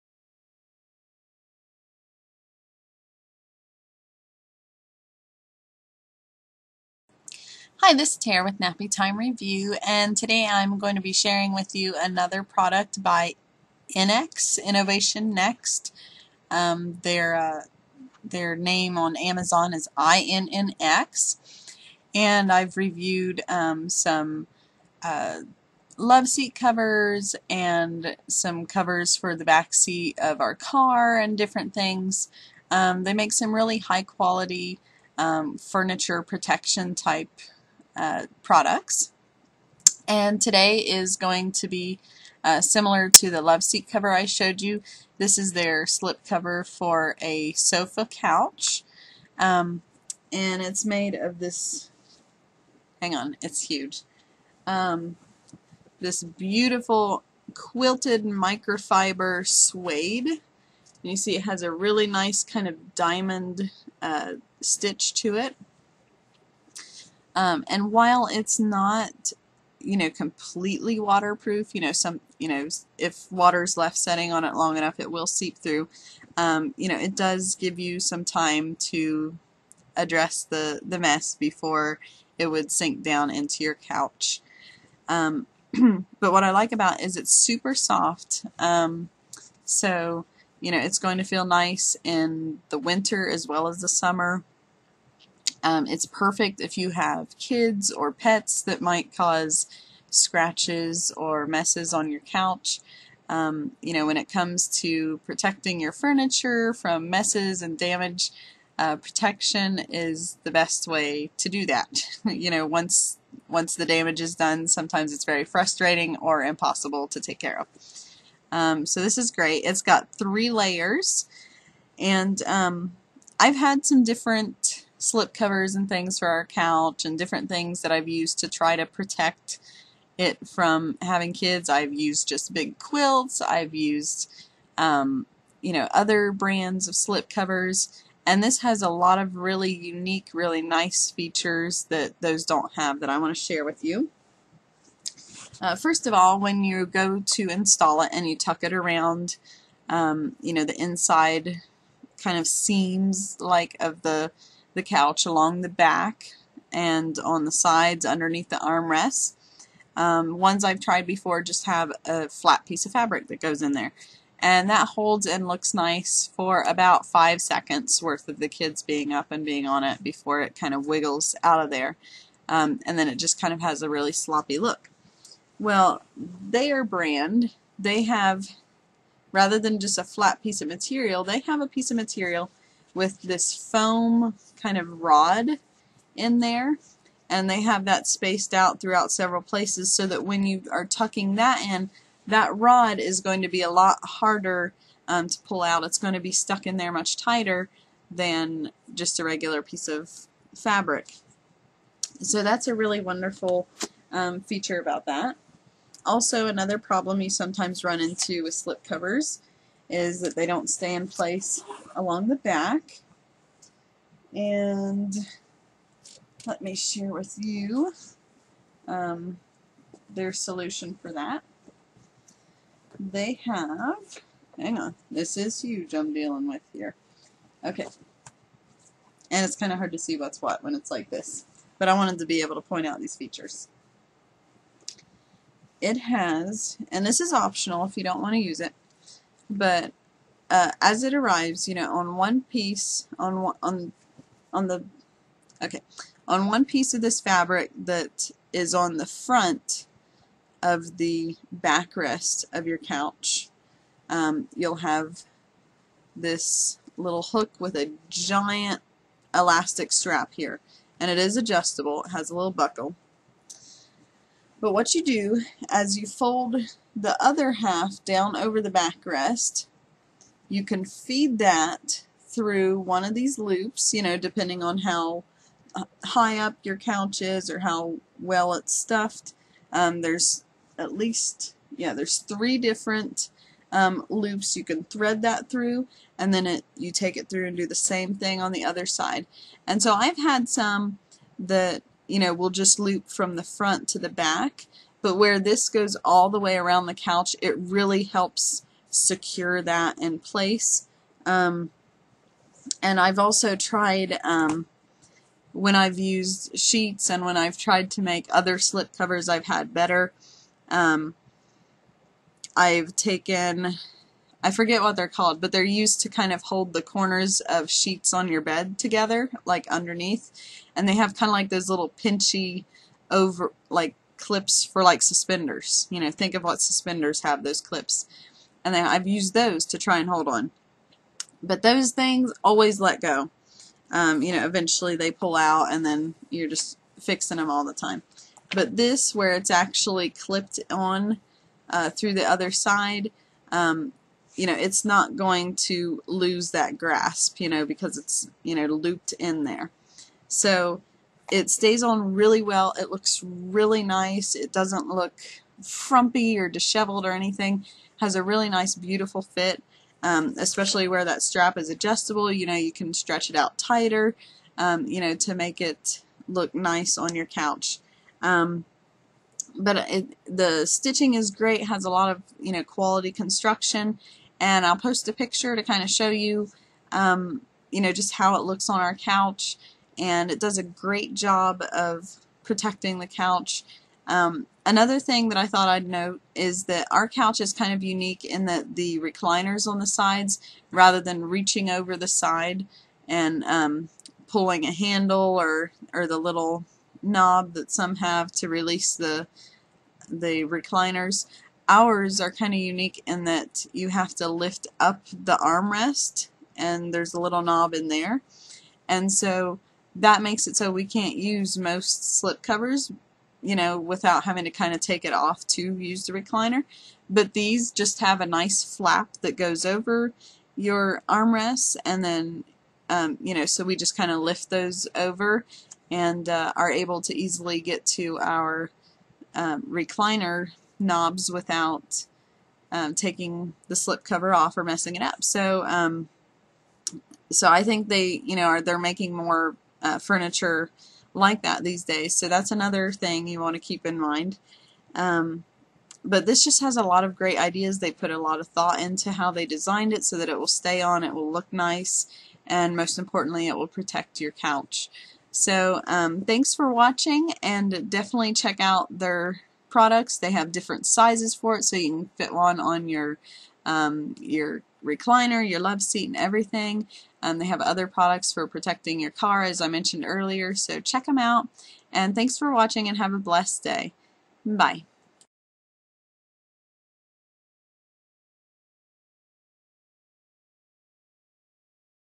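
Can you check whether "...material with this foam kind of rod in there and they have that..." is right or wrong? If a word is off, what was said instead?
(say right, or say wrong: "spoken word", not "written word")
right.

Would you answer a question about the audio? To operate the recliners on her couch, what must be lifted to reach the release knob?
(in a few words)
the armrest.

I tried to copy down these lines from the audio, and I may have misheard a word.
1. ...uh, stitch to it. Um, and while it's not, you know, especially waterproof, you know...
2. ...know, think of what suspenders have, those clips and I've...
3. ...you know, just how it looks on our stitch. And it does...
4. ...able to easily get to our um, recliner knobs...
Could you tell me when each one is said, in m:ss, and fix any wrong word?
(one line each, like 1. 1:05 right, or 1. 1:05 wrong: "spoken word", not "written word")
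1. 1:04 wrong: "completely", not "especially"
2. 5:26 right
3. 6:17 wrong: "couch", not "stitch"
4. 7:06 right.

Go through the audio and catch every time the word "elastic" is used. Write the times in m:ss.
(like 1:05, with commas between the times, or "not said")
4:19.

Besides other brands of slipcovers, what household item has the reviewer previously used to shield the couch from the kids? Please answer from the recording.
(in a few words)
big quilts.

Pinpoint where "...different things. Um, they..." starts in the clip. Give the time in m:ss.
0:31.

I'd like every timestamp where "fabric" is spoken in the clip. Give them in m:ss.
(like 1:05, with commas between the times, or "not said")
2:42, 3:20, 4:07.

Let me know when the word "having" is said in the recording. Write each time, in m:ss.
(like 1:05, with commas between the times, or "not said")
2:11, 6:54.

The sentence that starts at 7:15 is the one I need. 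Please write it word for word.
So, um, so I think they, you know, are they're making more uh, furniture like that these days.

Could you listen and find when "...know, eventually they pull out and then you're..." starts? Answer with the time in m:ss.
5:34.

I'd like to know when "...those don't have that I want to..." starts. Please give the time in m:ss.
2:22.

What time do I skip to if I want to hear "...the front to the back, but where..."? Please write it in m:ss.
4:53.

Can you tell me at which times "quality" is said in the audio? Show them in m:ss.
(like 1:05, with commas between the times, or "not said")
0:34, 6:12.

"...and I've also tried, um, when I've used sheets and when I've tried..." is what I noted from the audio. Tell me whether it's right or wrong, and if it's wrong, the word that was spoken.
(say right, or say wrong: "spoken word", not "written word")
right.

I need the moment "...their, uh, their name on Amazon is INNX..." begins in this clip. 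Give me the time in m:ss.
0:17.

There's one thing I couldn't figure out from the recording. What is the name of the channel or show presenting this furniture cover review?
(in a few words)
Nappy Time Review.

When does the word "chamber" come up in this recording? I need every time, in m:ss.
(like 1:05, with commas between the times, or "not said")
not said.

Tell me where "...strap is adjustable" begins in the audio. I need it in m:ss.
6:01.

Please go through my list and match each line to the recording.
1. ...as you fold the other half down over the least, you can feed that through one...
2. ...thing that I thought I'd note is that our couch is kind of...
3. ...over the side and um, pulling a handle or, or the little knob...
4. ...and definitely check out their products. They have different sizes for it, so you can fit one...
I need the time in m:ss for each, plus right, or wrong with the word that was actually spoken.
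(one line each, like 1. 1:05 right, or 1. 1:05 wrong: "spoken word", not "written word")
1. 4:25 wrong: "backrest", not "least"
2. 6:24 right
3. 6:31 right
4. 7:37 right.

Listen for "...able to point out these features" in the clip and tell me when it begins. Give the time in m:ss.
3:52.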